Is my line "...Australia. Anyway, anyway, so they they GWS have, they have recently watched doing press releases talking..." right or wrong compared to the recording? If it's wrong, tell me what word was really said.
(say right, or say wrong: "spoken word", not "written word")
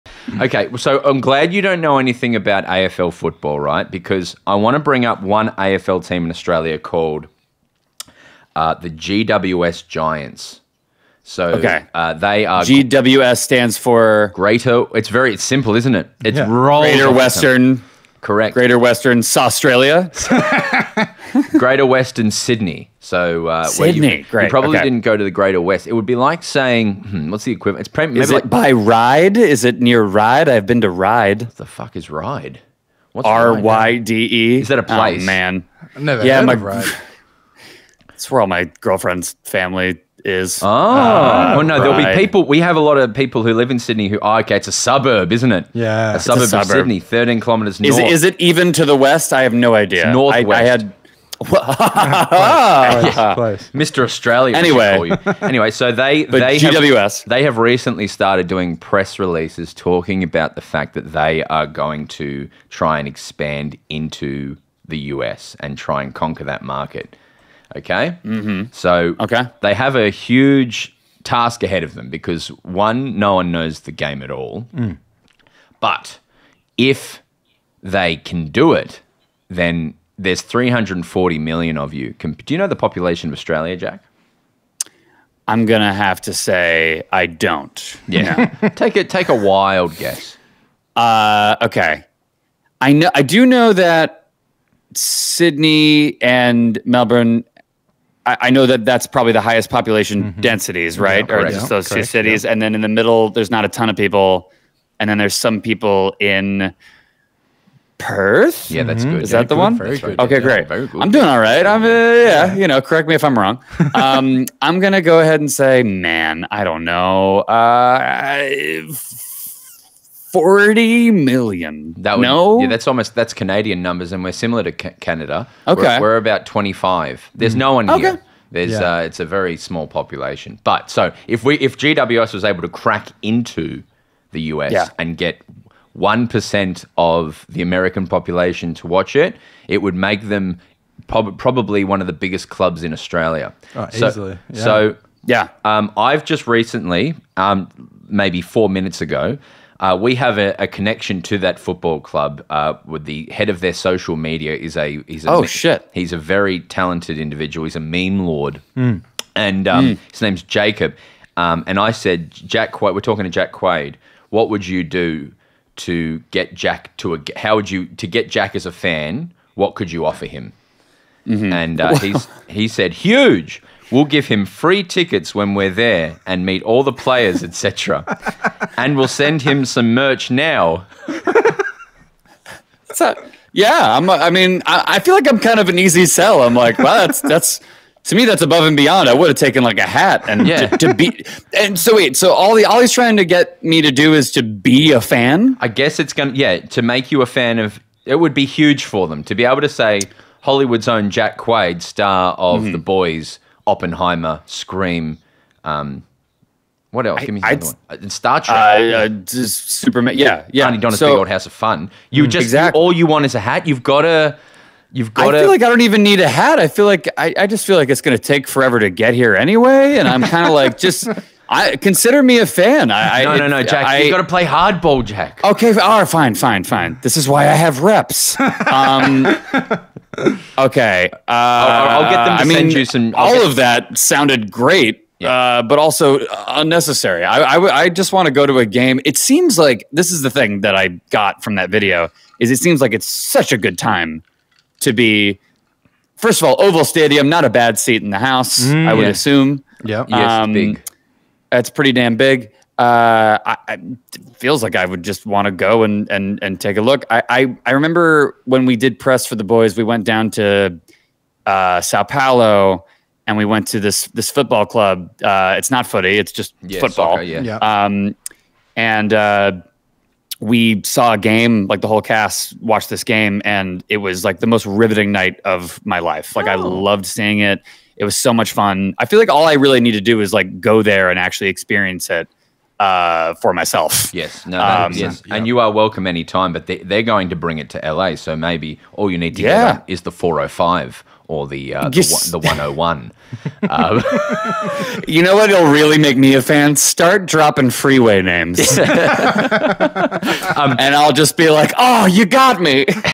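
wrong: "started", not "watched".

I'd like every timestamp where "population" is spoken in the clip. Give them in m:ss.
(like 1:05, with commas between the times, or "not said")
1:22, 1:39, 2:09, 2:18.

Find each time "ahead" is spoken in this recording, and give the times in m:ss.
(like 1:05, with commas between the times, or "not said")
1:11, 1:55.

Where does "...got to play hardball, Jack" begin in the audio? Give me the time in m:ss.
3:44.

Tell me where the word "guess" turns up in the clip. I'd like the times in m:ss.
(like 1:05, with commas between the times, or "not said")
1:29, 3:15.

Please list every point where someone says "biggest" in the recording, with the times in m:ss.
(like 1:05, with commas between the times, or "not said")
2:22.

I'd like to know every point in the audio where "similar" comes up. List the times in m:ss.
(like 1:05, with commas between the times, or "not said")
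2:04.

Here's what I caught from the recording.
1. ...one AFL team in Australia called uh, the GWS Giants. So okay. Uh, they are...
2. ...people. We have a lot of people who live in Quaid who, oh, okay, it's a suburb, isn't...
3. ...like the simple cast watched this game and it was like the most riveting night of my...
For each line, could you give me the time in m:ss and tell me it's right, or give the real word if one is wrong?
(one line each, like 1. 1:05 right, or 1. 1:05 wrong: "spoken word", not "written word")
1. 0:05 right
2. 0:42 wrong: "Sydney", not "Quaid"
3. 4:31 wrong: "whole", not "simple".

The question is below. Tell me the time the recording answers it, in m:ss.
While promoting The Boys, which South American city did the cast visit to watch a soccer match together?
4:21.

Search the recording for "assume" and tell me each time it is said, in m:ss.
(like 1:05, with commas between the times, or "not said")
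4:09.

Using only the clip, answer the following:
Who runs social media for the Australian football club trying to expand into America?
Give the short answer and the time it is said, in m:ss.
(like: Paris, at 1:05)
Jacob, at 2:40.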